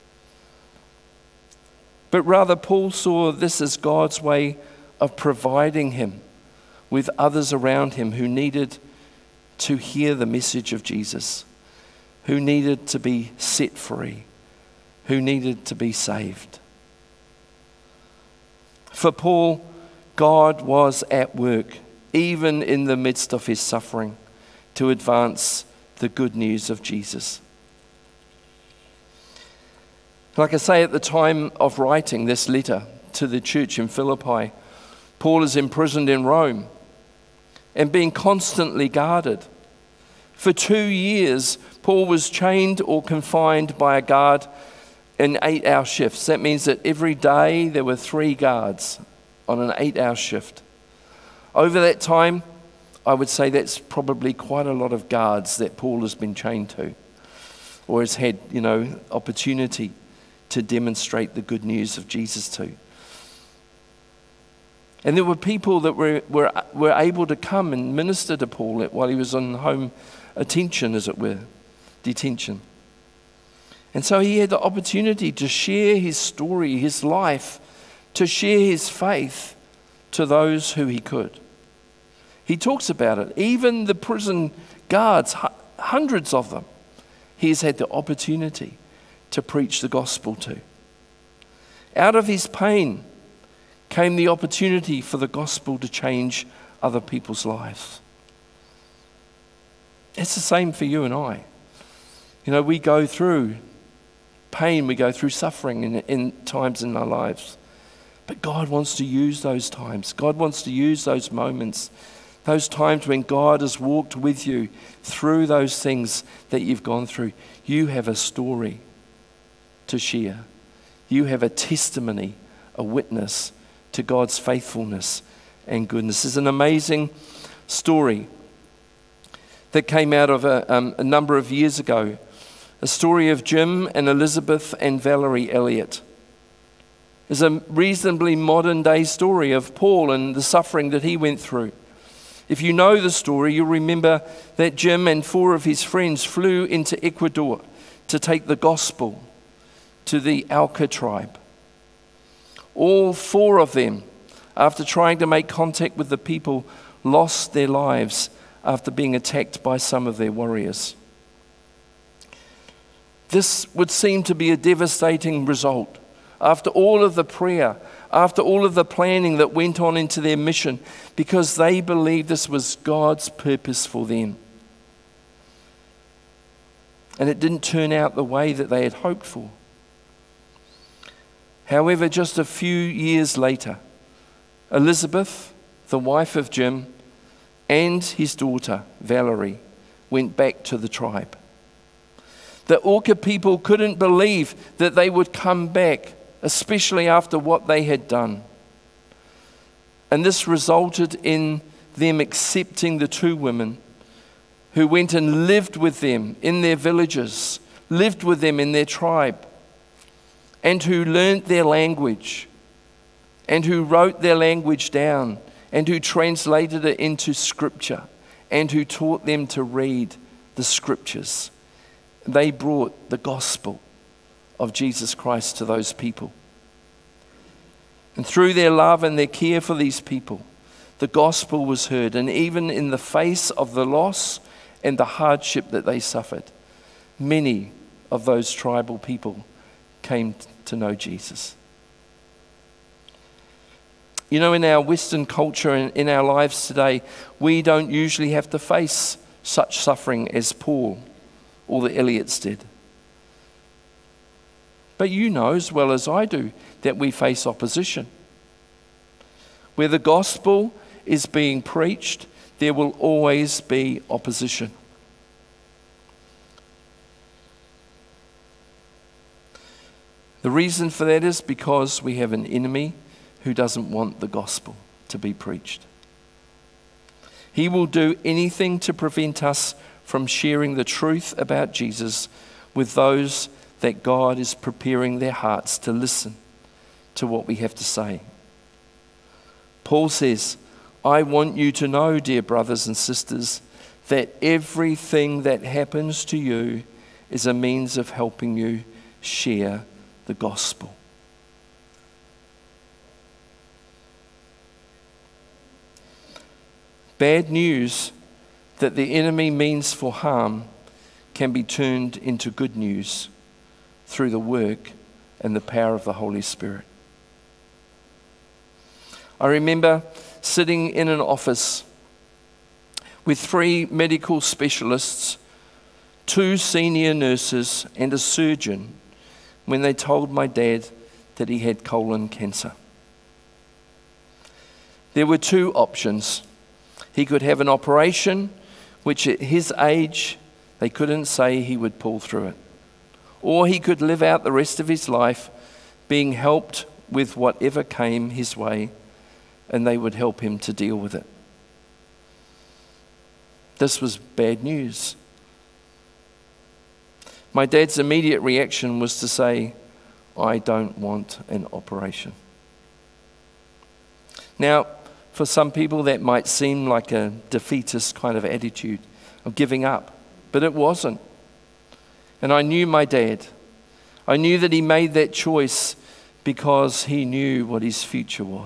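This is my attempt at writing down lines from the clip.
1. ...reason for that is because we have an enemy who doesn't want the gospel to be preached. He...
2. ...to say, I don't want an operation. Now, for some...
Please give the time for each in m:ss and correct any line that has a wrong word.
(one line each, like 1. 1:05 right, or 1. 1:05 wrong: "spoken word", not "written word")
1. 4:30 right
2. 5:59 right.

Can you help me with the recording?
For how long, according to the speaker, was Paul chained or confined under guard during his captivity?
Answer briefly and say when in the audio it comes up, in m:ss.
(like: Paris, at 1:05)
2 years, at 0:40.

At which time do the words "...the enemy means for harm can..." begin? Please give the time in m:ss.
5:08.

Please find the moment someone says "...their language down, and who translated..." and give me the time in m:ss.
3:34.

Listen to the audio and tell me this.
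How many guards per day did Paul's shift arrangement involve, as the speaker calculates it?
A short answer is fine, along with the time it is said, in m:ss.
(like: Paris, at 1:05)
3, at 0:47.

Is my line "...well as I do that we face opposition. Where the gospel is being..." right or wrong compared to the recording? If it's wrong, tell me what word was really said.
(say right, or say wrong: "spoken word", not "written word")
right.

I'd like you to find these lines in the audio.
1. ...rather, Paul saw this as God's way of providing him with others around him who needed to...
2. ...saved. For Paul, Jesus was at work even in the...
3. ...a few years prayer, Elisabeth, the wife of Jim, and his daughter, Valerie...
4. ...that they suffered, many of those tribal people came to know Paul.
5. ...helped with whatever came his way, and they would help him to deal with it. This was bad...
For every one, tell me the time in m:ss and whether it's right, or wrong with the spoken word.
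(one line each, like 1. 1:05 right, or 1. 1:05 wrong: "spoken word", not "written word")
1. 0:02 right
2. 0:15 wrong: "God", not "Jesus"
3. 3:02 wrong: "later", not "prayer"
4. 3:55 wrong: "Jesus", not "Paul"
5. 5:46 right.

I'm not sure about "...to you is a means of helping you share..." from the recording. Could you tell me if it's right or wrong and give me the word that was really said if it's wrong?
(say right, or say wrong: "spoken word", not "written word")
right.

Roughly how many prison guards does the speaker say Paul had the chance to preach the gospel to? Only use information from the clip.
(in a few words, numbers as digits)
hundreds.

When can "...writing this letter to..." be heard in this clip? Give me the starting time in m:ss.
0:31.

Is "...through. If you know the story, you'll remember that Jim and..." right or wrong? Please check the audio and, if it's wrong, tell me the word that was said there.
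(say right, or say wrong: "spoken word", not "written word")
right.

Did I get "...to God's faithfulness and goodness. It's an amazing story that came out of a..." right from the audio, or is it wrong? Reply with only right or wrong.
right.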